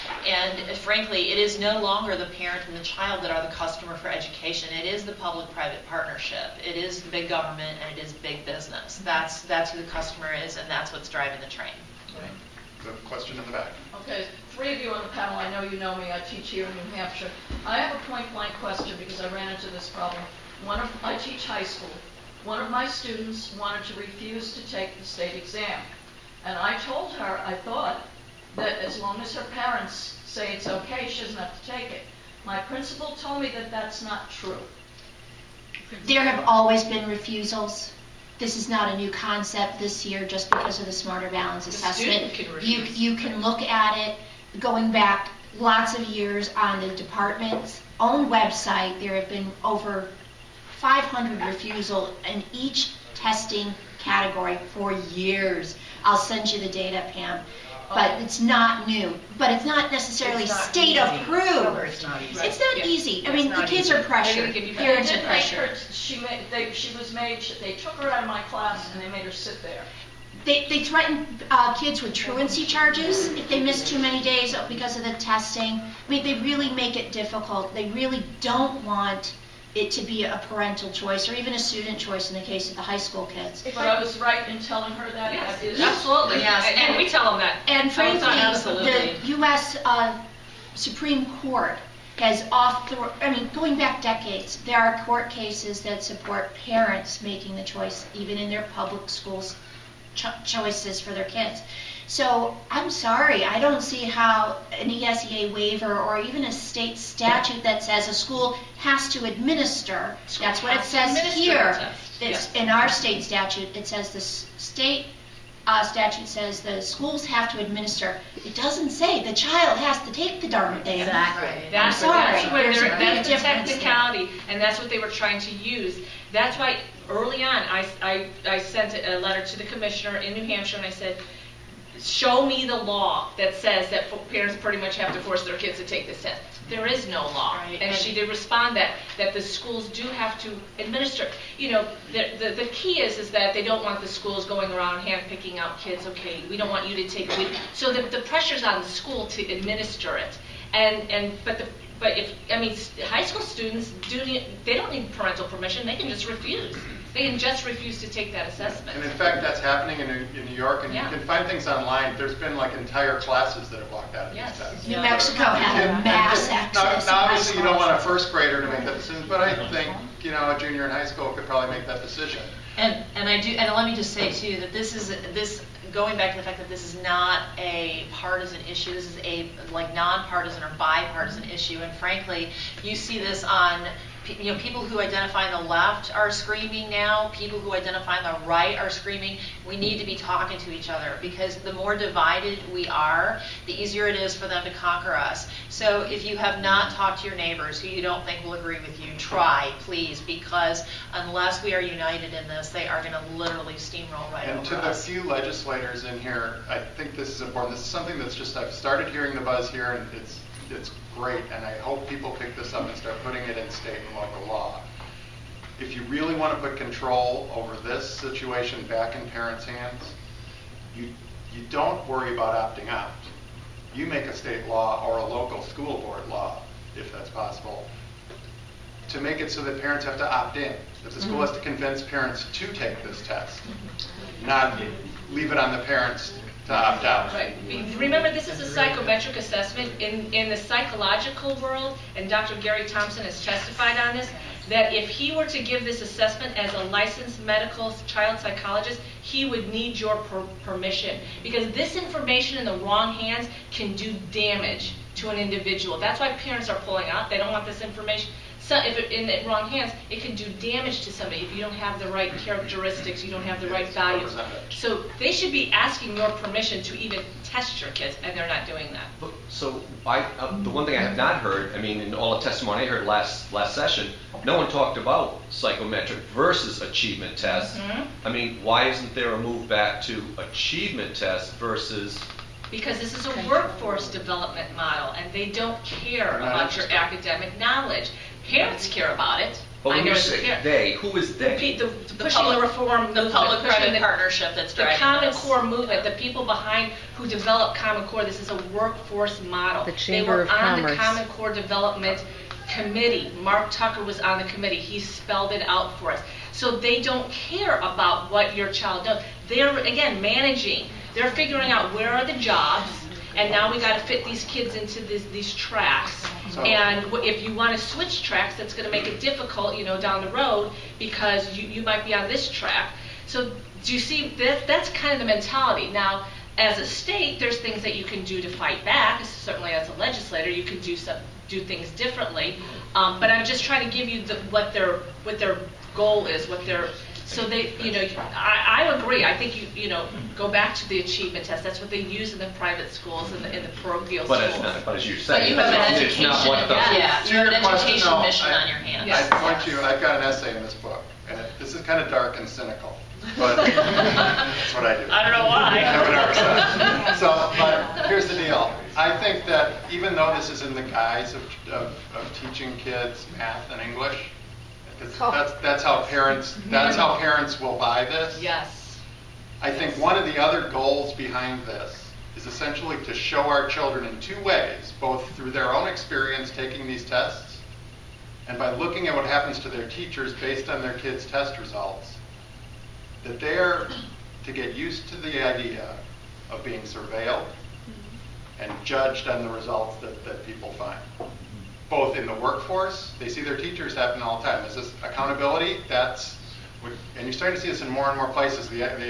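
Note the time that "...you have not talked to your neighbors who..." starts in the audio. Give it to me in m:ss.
3:16.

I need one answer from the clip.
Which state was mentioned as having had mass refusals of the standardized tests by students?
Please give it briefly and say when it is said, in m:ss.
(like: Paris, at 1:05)
New Mexico, at 2:44.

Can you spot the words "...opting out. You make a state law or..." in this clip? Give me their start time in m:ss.
3:42.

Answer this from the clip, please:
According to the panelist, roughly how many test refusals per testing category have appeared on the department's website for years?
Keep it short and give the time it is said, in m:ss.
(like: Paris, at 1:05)
over 500, at 0:49.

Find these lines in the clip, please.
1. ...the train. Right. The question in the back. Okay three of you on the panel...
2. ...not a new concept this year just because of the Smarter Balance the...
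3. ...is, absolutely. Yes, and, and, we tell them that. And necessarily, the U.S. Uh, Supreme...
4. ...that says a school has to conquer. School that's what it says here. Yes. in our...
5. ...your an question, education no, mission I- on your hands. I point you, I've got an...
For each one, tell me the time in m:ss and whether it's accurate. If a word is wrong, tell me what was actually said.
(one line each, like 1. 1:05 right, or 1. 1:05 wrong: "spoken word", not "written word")
1. 0:11 right
2. 0:38 right
3. 1:25 wrong: "frankly", not "necessarily"
4. 1:47 wrong: "administer", not "conquer"
5. 5:47 right.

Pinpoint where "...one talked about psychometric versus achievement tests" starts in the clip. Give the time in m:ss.
4:34.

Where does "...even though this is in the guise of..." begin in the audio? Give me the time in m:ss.
5:59.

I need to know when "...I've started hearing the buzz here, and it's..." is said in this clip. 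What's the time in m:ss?
3:28.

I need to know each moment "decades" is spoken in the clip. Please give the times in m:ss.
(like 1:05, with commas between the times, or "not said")
1:34.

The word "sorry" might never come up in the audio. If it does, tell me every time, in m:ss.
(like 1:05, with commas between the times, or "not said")
1:42, 2:02.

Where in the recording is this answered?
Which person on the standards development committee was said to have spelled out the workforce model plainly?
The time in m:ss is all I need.
5:03.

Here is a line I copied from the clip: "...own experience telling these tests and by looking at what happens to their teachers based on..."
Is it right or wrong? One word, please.
wrong.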